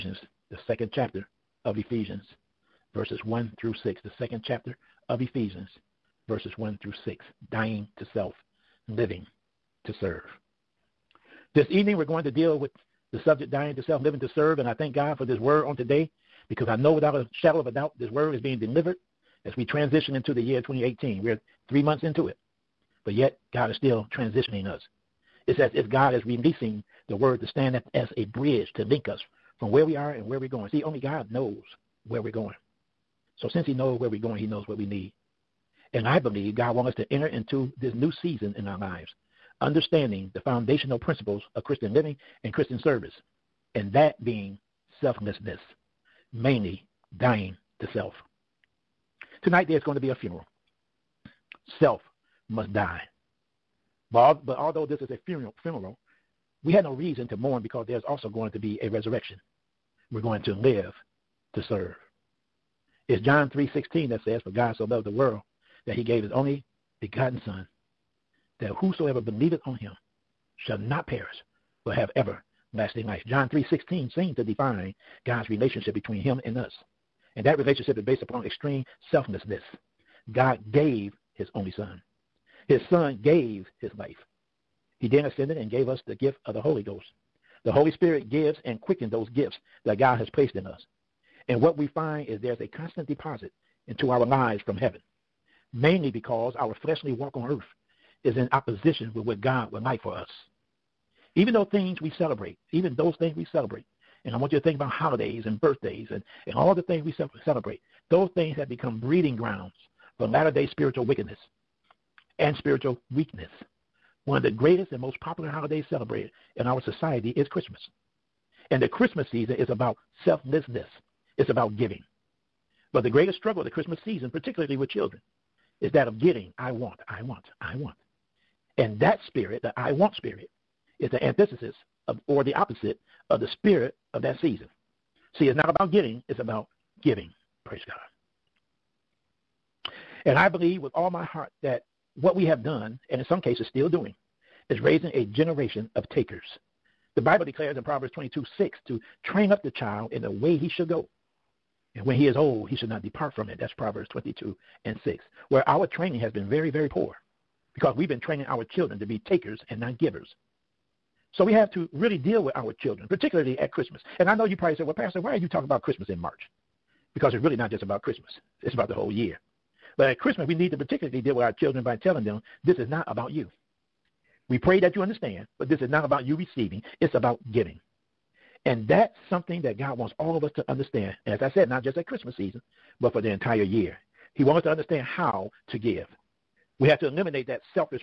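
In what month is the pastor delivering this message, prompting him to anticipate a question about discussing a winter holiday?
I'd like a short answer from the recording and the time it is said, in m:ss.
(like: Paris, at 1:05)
March, at 2:46.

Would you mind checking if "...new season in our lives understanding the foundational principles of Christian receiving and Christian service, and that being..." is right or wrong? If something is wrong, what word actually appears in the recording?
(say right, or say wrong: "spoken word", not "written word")
wrong: "living", not "receiving".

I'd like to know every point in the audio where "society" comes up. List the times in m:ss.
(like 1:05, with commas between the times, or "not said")
1:56.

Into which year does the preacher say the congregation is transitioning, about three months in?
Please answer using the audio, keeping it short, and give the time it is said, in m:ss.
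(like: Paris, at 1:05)
2018, at 0:20.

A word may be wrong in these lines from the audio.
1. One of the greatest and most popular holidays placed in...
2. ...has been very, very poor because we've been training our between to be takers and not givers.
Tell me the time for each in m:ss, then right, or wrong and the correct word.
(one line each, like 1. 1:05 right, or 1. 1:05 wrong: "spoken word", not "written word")
1. 1:54 wrong: "celebrated", not "placed"
2. 2:36 wrong: "children", not "between".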